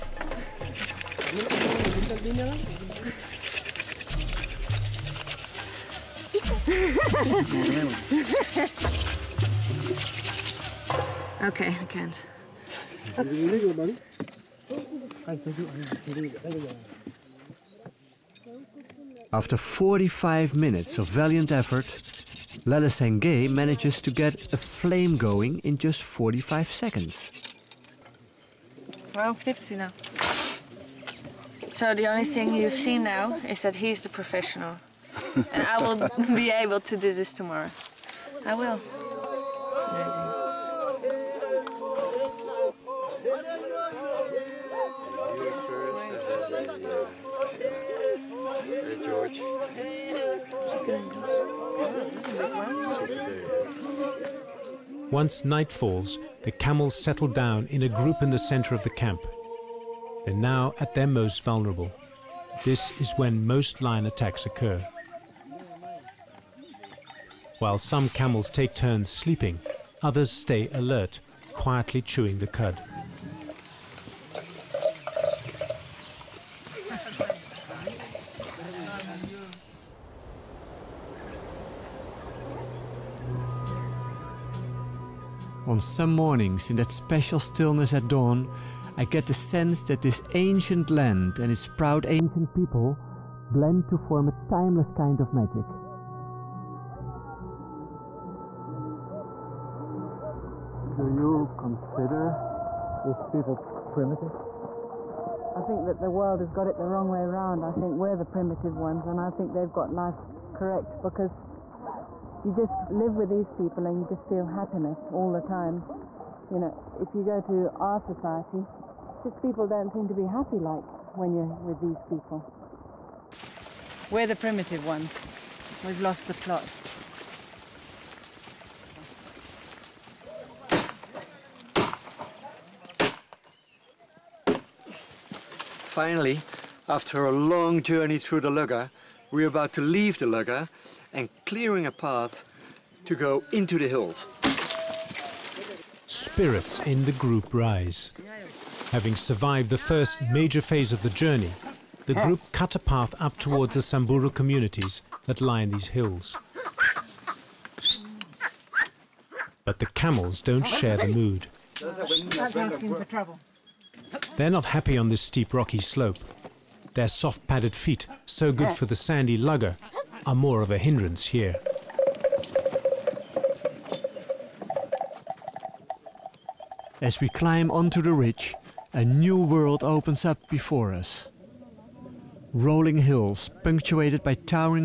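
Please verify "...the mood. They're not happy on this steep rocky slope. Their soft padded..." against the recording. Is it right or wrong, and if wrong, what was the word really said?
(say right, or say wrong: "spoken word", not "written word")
right.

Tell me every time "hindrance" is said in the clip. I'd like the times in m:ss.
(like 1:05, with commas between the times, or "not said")
2:50.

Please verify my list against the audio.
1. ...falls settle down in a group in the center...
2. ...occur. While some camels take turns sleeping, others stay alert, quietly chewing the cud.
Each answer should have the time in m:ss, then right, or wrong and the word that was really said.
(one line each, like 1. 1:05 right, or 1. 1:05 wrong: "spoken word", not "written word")
1. 0:56 wrong: "camels", not "falls"
2. 1:04 right.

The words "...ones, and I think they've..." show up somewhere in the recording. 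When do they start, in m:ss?
1:48.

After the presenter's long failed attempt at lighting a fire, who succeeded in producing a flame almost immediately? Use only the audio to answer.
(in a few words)
Lelesenge.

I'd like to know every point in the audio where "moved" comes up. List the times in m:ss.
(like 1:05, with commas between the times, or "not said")
not said.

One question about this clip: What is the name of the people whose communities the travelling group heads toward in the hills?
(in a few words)
Samburu.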